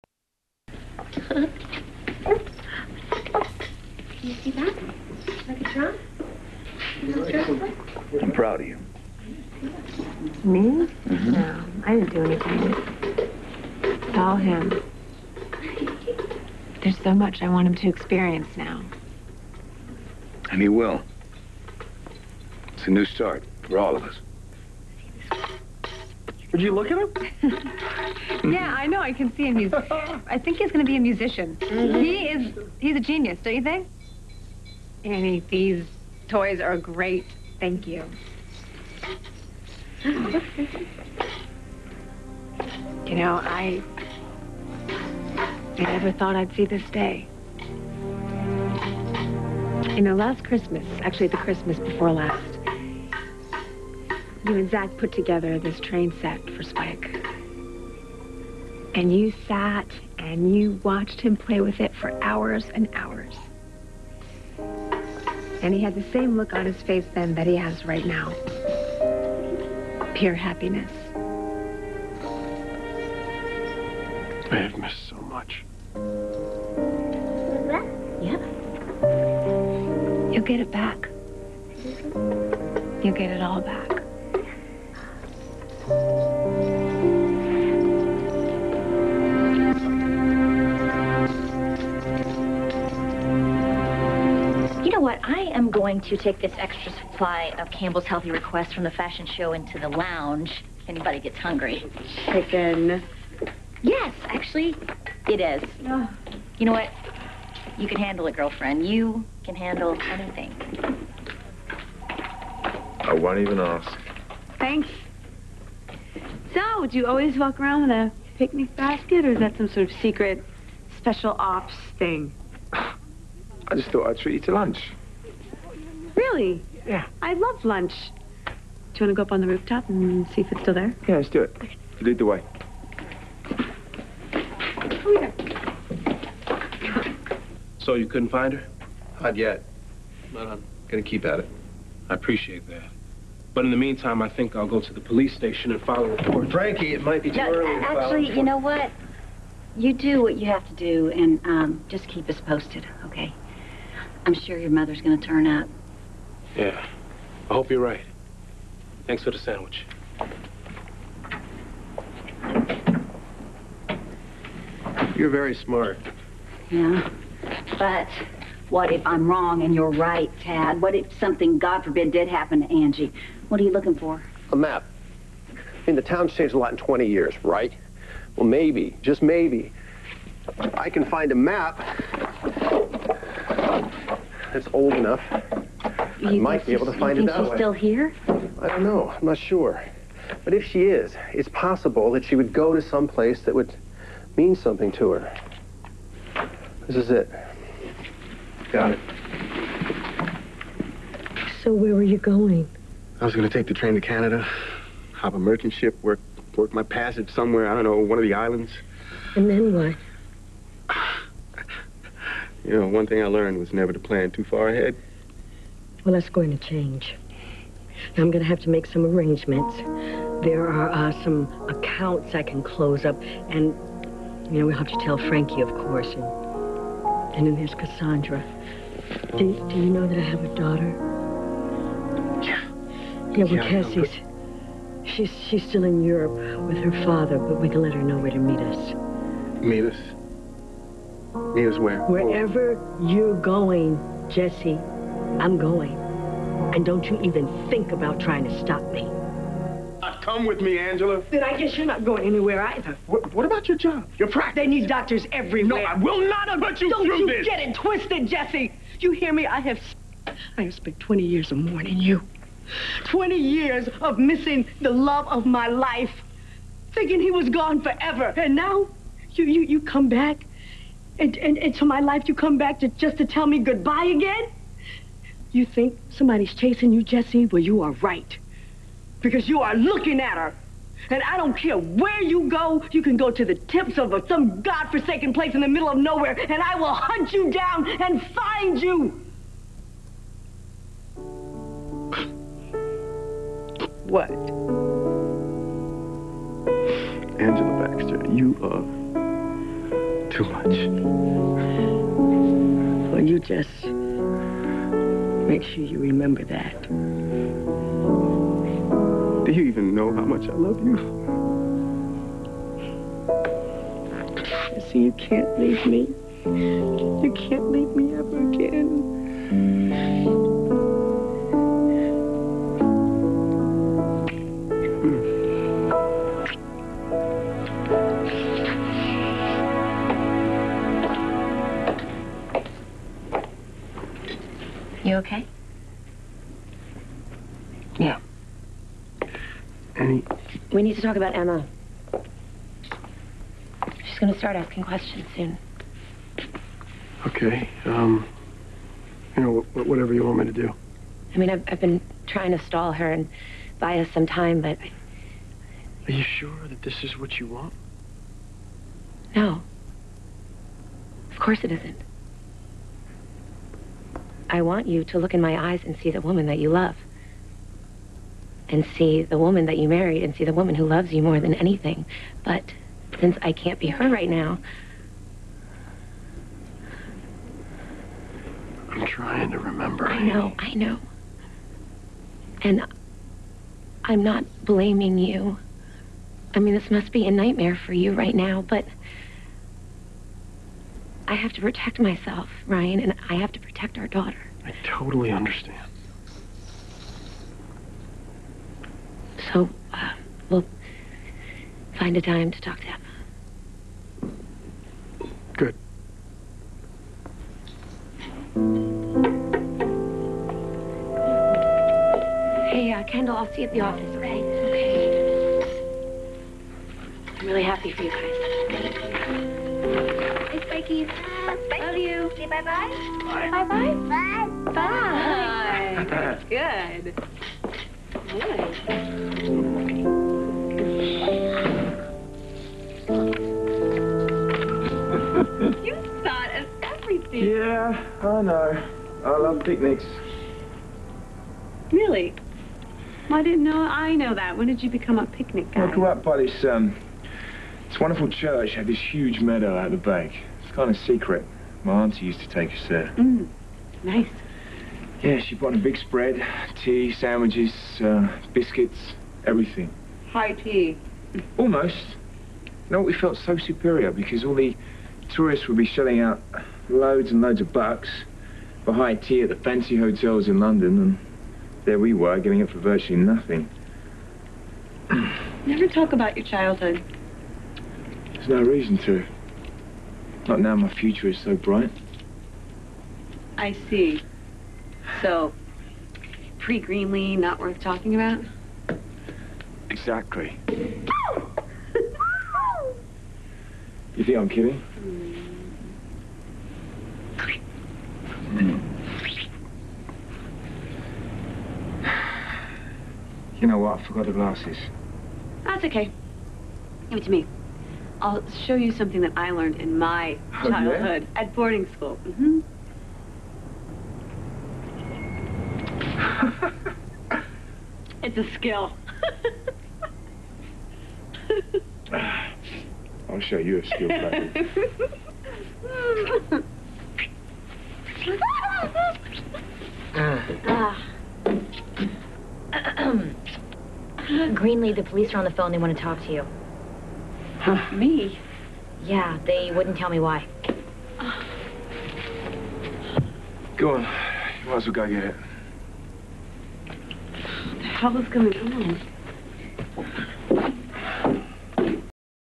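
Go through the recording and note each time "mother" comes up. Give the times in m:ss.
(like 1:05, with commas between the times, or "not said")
2:34.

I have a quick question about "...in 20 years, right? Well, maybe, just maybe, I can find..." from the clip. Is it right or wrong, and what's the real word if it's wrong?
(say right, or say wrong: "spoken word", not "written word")
right.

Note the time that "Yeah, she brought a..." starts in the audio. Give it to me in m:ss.
7:35.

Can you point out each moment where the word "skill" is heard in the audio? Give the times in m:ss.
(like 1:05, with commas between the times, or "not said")
8:38, 8:43.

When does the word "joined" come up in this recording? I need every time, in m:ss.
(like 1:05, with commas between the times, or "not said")
not said.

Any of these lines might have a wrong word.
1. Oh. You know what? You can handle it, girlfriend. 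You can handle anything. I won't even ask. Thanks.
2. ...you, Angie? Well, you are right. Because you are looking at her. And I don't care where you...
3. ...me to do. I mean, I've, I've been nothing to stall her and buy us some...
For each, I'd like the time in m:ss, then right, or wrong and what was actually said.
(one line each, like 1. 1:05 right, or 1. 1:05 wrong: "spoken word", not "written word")
1. 1:45 right
2. 4:36 wrong: "Jesse", not "Angie"
3. 5:50 wrong: "trying", not "nothing".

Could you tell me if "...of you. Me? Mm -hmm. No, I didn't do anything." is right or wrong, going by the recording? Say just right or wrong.
right.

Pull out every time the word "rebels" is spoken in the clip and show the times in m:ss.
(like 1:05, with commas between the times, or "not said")
not said.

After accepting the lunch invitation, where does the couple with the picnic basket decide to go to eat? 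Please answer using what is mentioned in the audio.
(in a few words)
the rooftop.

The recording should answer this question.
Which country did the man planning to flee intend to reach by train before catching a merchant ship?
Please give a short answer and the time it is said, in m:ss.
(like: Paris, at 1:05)
Canada, at 3:24.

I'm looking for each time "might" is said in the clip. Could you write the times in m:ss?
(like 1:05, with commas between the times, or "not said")
2:27, 3:06, 9:04.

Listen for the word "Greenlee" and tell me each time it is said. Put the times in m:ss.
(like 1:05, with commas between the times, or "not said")
8:06, 8:54.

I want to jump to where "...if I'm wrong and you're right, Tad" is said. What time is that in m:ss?
2:48.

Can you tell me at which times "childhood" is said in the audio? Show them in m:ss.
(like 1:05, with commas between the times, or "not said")
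7:56, 8:30.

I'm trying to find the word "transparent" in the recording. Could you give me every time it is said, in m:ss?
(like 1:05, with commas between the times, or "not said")
not said.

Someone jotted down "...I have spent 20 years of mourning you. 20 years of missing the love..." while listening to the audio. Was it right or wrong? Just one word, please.
right.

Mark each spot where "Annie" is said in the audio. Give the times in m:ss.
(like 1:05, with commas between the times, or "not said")
0:35, 5:39.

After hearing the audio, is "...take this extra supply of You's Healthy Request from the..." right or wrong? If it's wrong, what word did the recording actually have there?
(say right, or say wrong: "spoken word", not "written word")
wrong: "Campbell", not "You".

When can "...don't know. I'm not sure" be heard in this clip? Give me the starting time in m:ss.
3:08.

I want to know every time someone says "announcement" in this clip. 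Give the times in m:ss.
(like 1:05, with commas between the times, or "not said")
not said.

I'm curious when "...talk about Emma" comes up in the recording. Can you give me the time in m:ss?
5:41.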